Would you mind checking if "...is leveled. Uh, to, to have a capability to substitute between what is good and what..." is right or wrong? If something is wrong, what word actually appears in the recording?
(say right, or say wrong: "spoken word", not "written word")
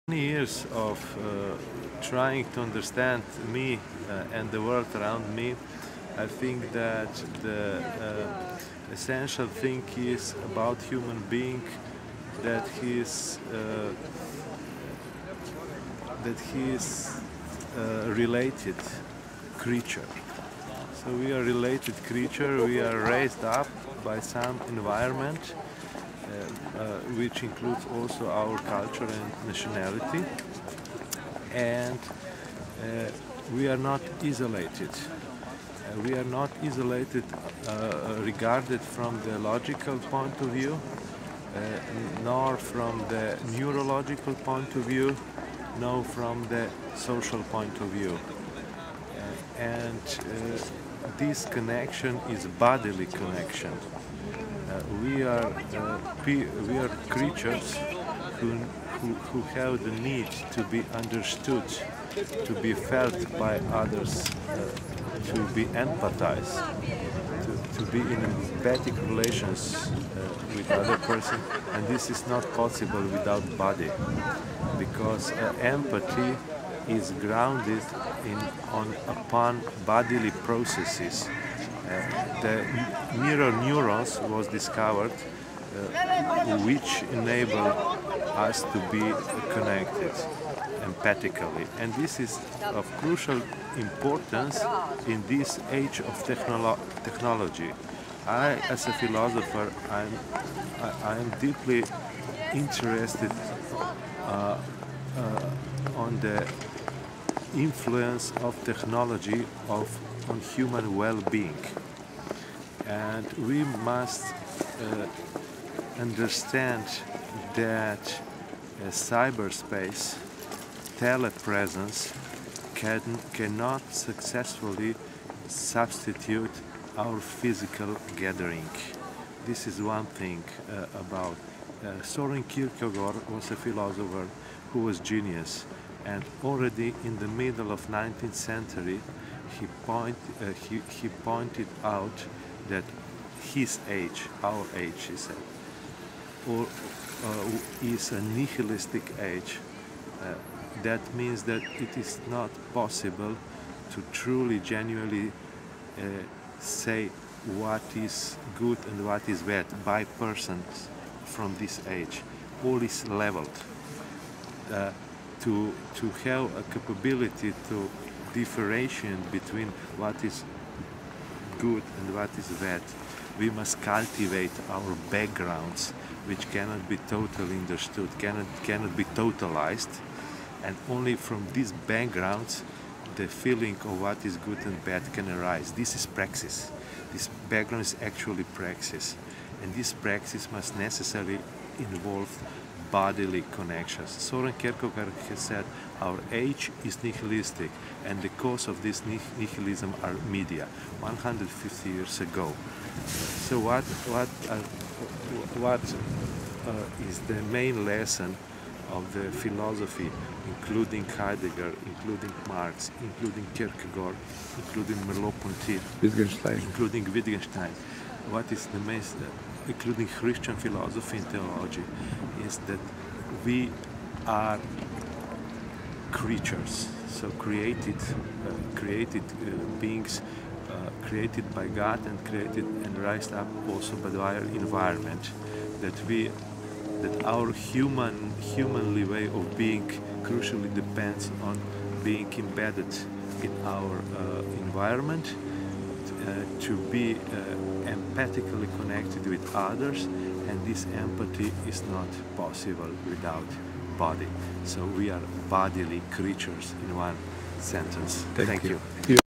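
wrong: "differentiate", not "substitute".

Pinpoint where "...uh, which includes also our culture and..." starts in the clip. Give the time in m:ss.
0:26.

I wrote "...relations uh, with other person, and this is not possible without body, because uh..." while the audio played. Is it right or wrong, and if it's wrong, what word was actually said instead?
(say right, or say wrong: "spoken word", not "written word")
right.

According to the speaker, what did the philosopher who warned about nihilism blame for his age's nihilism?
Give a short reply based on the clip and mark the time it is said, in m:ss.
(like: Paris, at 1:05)
Media, at 3:20.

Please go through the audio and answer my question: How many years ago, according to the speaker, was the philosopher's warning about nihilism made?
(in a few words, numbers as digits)
150.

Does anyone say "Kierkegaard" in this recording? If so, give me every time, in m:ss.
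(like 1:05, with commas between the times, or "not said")
2:12, 3:14, 3:33.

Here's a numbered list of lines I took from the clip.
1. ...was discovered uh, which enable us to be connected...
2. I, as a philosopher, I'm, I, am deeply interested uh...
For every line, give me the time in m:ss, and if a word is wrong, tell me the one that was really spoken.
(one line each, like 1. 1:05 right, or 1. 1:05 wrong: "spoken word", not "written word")
1. 1:24 right
2. 1:38 right.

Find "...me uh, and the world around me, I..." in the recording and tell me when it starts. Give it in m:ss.
0:03.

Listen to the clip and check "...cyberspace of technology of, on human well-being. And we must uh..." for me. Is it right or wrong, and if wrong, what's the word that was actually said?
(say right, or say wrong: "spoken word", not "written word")
wrong: "influence", not "cyberspace".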